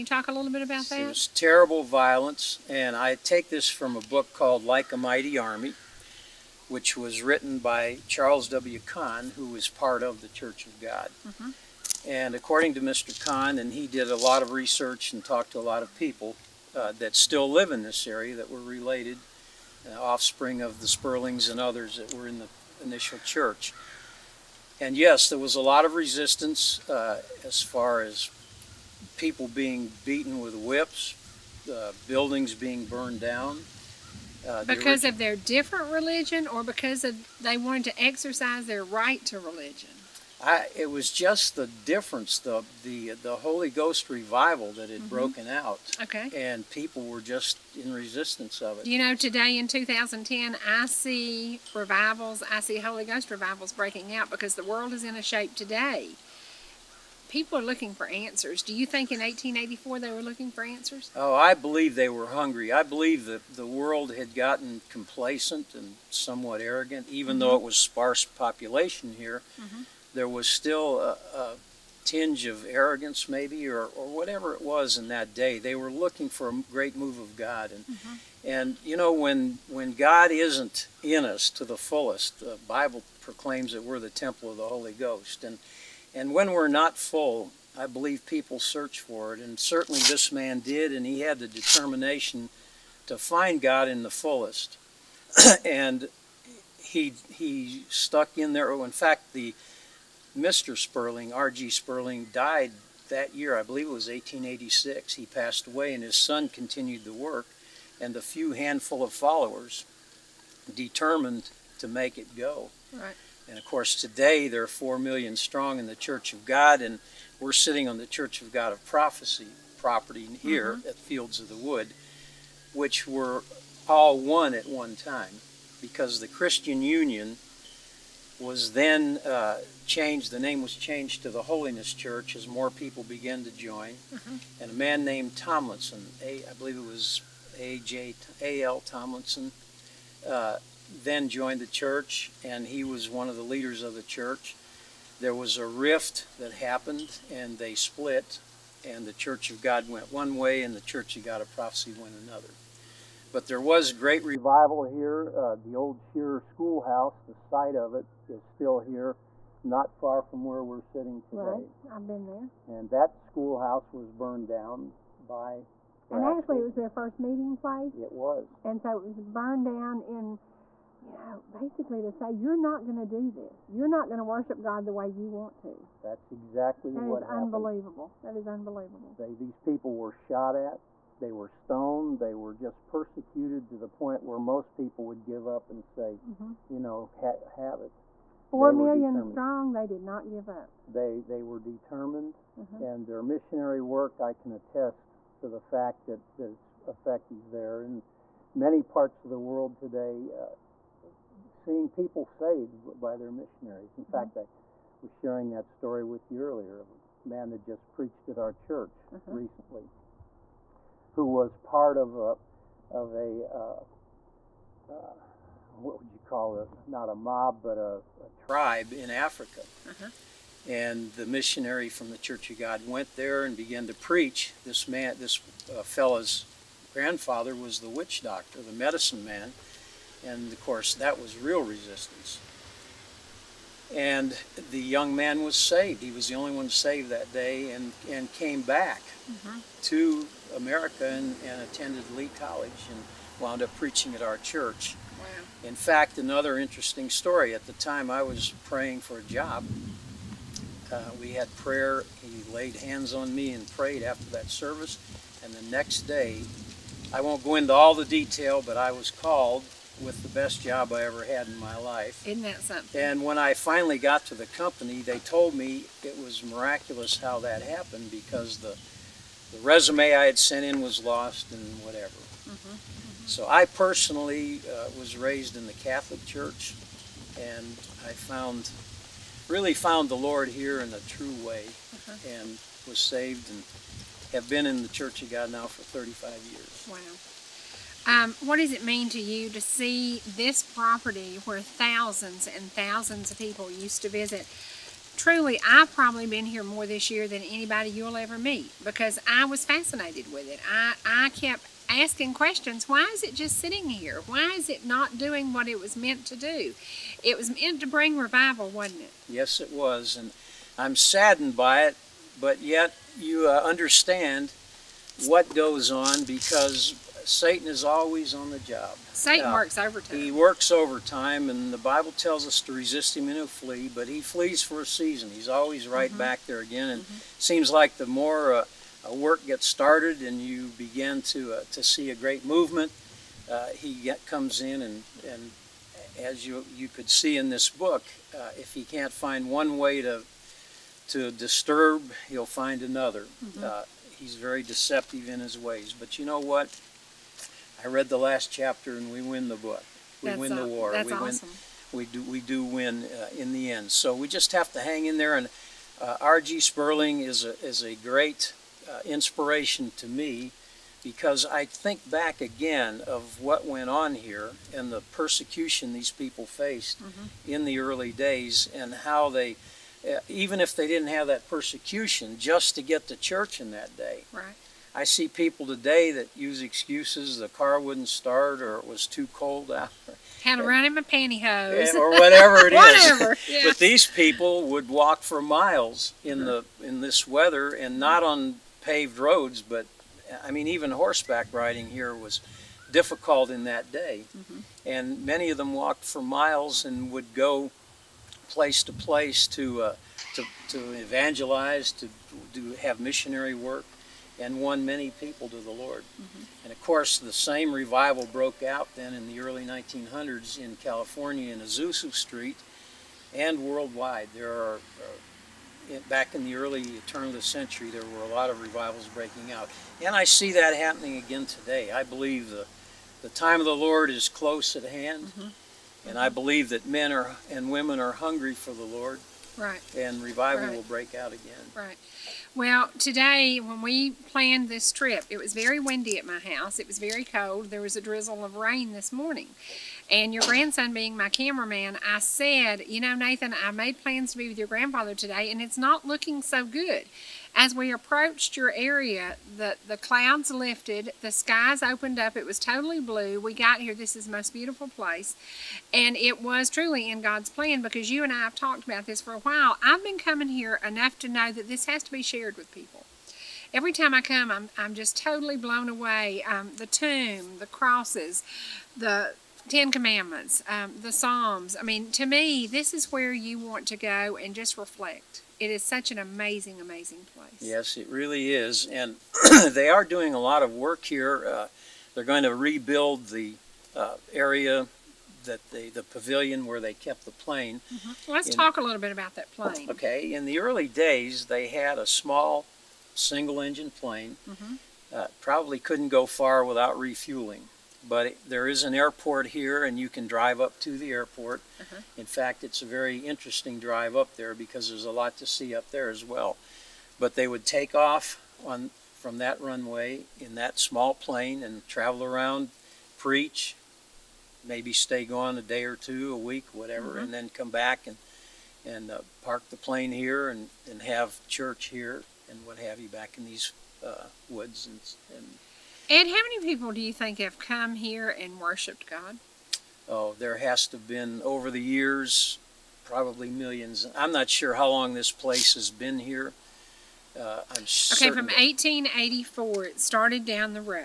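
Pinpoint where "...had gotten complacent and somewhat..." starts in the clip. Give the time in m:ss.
1:04.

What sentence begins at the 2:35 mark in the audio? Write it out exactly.
Uh, the old Shearer Schoolhouse, the site of it, is still here, not far from where we're sitting today.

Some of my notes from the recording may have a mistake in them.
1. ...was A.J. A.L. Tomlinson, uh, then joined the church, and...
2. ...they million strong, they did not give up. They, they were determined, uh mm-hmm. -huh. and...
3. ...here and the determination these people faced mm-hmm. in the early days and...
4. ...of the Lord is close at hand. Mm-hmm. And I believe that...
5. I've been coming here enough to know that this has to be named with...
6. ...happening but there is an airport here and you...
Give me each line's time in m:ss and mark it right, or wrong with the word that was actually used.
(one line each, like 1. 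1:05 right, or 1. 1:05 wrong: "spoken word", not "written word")
1. 2:16 right
2. 3:08 right
3. 6:04 wrong: "persecution", not "determination"
4. 7:03 right
5. 7:39 wrong: "shared", not "named"
6. 8:16 wrong: "refueling", not "happening".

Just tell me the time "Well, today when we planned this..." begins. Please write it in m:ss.
7:12.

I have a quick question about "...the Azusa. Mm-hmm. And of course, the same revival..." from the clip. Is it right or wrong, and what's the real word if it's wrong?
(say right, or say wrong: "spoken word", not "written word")
wrong: "Lord", not "Azusa".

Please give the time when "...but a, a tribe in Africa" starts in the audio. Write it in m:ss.
3:37.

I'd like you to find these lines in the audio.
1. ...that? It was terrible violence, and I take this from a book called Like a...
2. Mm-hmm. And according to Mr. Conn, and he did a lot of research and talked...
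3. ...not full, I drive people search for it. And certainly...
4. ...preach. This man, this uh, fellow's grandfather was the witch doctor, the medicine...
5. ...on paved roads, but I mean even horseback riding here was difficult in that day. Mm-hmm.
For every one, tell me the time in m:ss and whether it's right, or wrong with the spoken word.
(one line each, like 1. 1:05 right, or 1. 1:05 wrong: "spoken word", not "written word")
1. 0:00 right
2. 0:11 right
3. 1:26 wrong: "believe", not "drive"
4. 3:43 right
5. 6:28 right.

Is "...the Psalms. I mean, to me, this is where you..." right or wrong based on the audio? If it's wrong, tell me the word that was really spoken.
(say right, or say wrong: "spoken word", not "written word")
right.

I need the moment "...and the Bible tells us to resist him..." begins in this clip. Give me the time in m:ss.
5:21.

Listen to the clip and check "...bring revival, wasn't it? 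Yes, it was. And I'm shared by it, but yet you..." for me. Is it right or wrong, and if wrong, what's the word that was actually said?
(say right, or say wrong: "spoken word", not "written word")
wrong: "saddened", not "shared".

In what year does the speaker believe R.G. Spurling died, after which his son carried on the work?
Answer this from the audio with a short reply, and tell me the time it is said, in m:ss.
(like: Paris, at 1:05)
1886, at 1:44.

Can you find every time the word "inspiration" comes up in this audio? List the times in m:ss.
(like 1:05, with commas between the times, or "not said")
5:59.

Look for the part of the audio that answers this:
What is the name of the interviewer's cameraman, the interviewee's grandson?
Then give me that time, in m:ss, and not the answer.
7:23.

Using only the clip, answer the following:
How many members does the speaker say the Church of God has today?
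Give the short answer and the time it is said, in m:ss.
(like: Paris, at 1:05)
4 million, at 1:54.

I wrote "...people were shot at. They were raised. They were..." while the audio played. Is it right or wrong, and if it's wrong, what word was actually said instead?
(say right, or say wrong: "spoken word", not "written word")
wrong: "stoned", not "raised".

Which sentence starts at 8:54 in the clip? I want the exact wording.
I'm not sure how long this place has been here.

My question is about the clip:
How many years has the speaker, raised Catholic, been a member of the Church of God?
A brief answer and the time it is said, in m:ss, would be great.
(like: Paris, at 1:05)
35 years, at 4:45.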